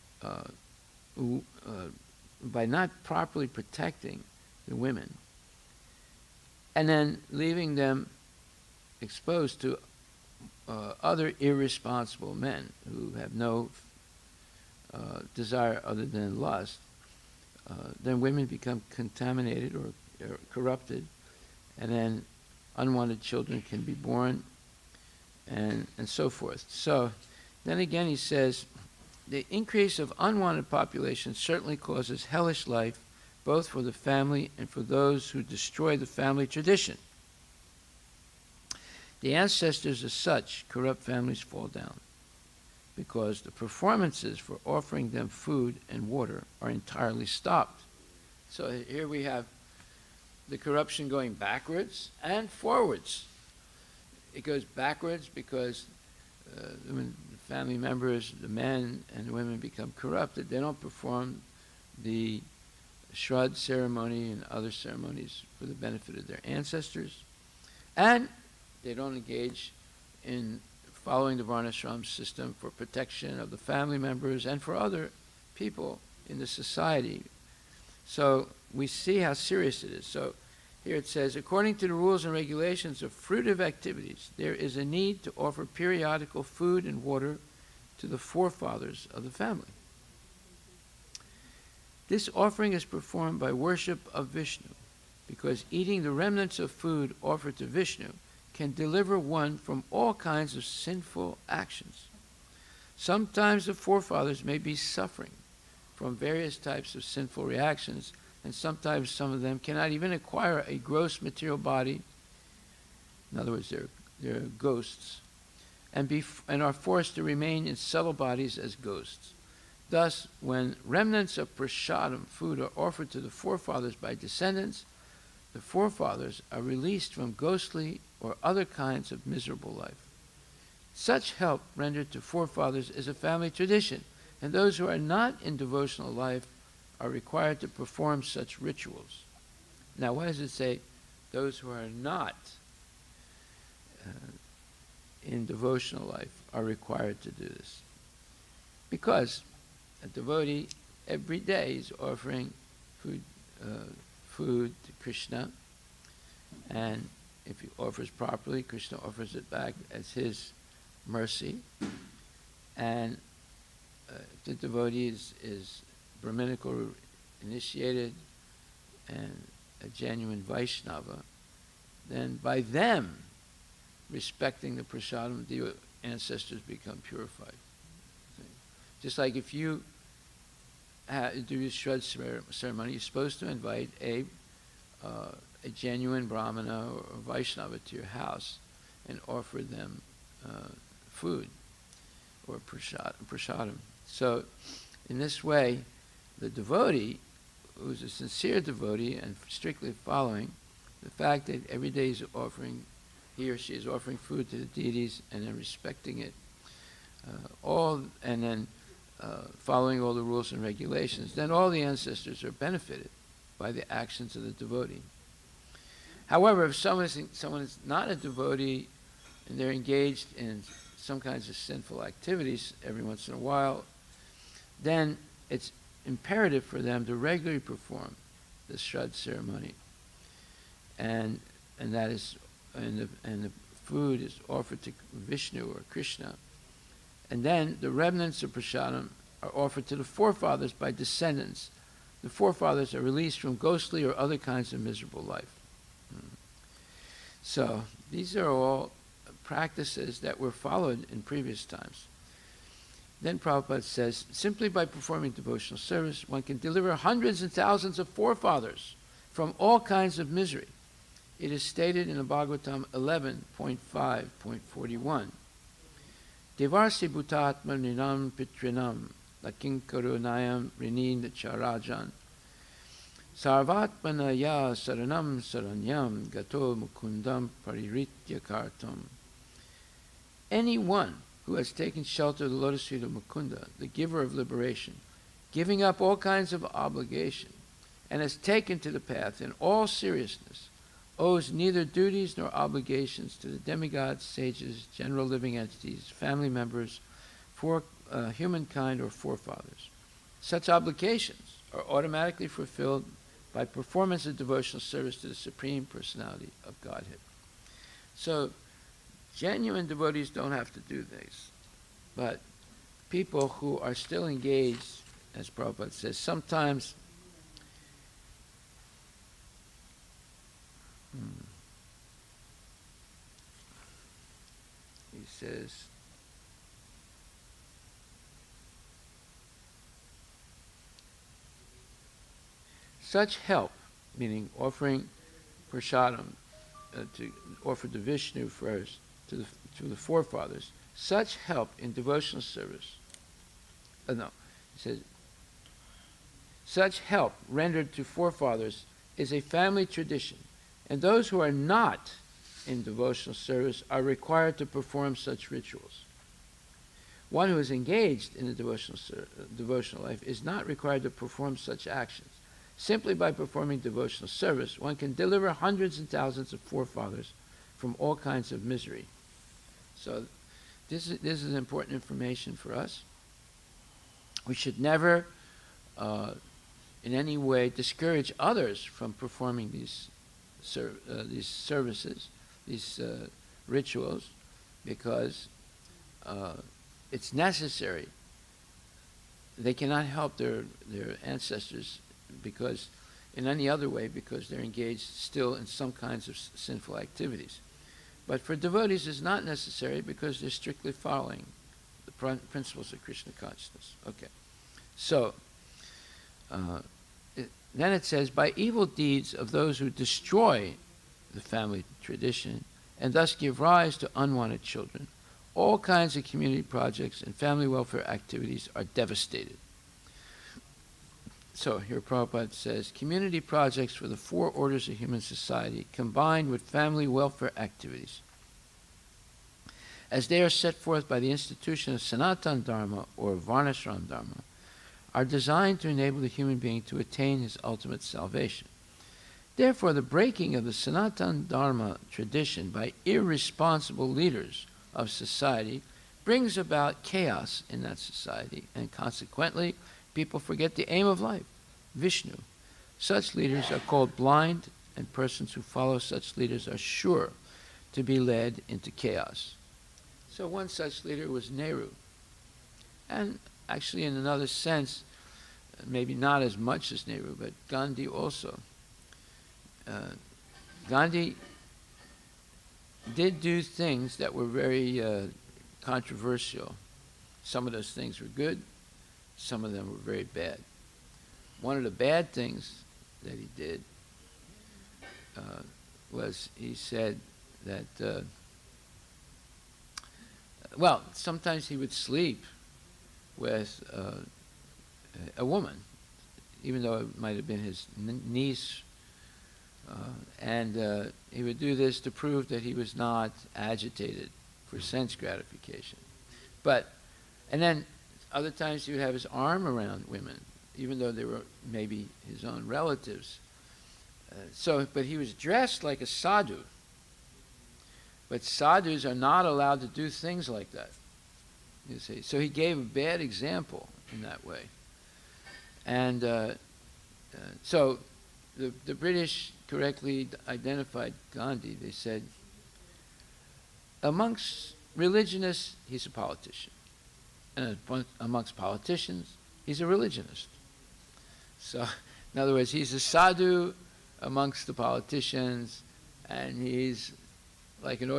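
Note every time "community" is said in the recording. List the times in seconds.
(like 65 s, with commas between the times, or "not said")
416 s, 422 s.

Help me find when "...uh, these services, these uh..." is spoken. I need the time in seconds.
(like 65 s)
381 s.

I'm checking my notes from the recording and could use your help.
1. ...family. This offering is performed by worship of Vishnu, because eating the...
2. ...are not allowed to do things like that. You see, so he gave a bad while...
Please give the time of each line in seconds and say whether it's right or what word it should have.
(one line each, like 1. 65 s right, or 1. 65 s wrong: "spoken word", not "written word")
1. 89 s right
2. 519 s wrong: "example", not "while".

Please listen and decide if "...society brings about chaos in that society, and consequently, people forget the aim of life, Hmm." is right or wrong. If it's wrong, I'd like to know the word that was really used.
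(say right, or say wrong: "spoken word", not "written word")
wrong: "Vishnu", not "Hmm".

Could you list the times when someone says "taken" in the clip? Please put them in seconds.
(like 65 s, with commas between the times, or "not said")
281 s, 288 s.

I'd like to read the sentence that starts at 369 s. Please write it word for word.
So this is, this is important information for us.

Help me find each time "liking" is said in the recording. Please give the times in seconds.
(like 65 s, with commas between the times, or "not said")
not said.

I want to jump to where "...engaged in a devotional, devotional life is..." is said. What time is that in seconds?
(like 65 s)
357 s.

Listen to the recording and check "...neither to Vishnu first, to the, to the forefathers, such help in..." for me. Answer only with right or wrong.
wrong.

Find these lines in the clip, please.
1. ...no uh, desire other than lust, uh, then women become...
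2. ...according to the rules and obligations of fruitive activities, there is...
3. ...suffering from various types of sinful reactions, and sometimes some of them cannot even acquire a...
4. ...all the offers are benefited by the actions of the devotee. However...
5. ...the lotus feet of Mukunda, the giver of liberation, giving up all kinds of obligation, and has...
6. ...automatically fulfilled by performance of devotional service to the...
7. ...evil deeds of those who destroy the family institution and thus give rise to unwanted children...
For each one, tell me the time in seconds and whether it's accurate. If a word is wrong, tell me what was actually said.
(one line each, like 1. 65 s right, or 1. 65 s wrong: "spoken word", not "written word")
1. 13 s right
2. 81 s wrong: "regulations", not "obligations"
3. 104 s right
4. 211 s wrong: "ancestors", not "offers"
5. 282 s right
6. 301 s right
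7. 408 s wrong: "tradition", not "institution".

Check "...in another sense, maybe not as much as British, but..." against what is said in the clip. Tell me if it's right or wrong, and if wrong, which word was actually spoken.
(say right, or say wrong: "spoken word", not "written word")
wrong: "Nehru", not "British".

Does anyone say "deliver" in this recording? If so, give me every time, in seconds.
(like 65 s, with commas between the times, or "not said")
98 s, 256 s, 365 s.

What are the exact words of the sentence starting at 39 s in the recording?
The ancestors of such corrupt families fall down because the performances for offering them food and water are entirely stopped.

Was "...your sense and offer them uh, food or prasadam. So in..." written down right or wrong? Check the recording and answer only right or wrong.
wrong.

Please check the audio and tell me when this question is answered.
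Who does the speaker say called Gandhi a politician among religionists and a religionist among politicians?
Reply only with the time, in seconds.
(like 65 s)
528 s.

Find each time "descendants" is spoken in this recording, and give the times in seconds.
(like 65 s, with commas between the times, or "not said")
124 s, 240 s.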